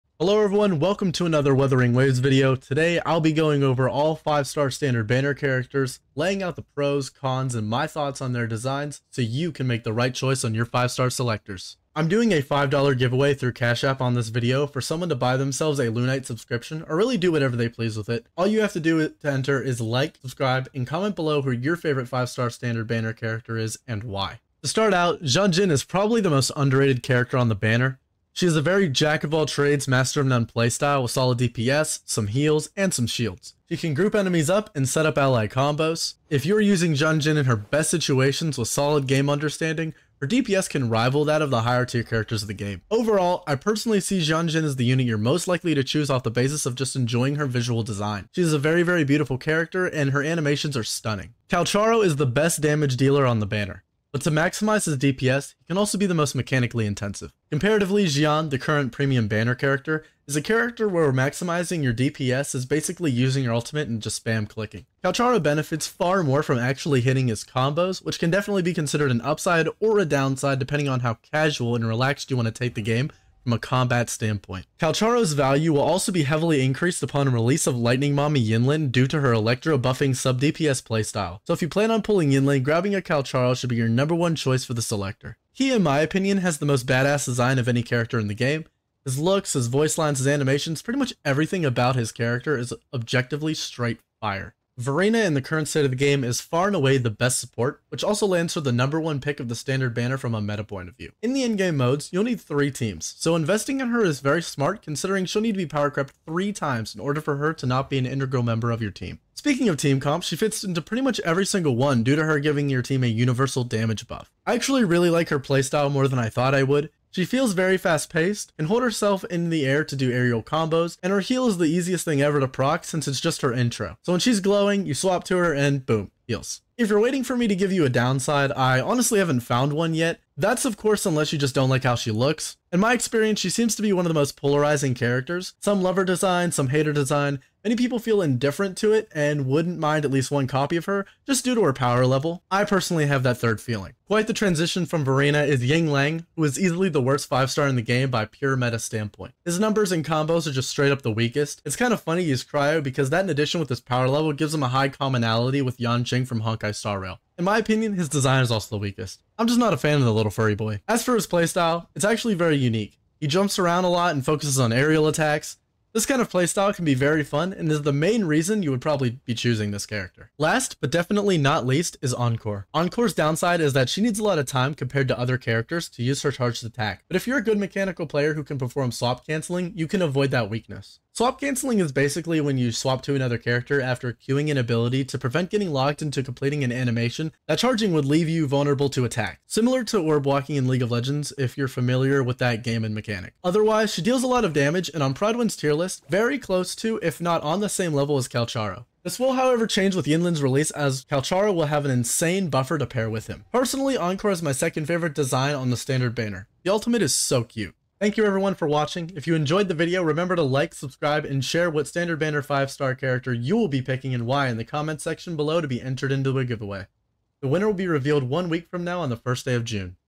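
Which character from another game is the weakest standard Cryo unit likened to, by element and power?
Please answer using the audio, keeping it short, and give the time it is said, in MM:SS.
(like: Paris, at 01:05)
Yanqing, at 02:35.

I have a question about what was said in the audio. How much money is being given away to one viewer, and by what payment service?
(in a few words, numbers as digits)
$5 via Cash App.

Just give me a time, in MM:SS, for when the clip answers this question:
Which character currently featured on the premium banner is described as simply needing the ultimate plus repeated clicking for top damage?
00:58.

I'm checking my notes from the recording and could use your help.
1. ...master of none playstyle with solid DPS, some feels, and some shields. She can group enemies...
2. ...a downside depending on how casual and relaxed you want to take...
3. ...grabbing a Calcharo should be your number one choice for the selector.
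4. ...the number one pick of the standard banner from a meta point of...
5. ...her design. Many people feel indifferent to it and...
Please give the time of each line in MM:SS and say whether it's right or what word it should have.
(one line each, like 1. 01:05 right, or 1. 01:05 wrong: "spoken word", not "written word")
1. 00:29 wrong: "heals", not "feels"
2. 01:09 right
3. 01:22 right
4. 01:38 right
5. 02:16 right.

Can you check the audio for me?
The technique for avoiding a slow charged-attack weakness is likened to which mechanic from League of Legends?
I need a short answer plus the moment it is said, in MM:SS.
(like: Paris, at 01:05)
orb walking, at 03:10.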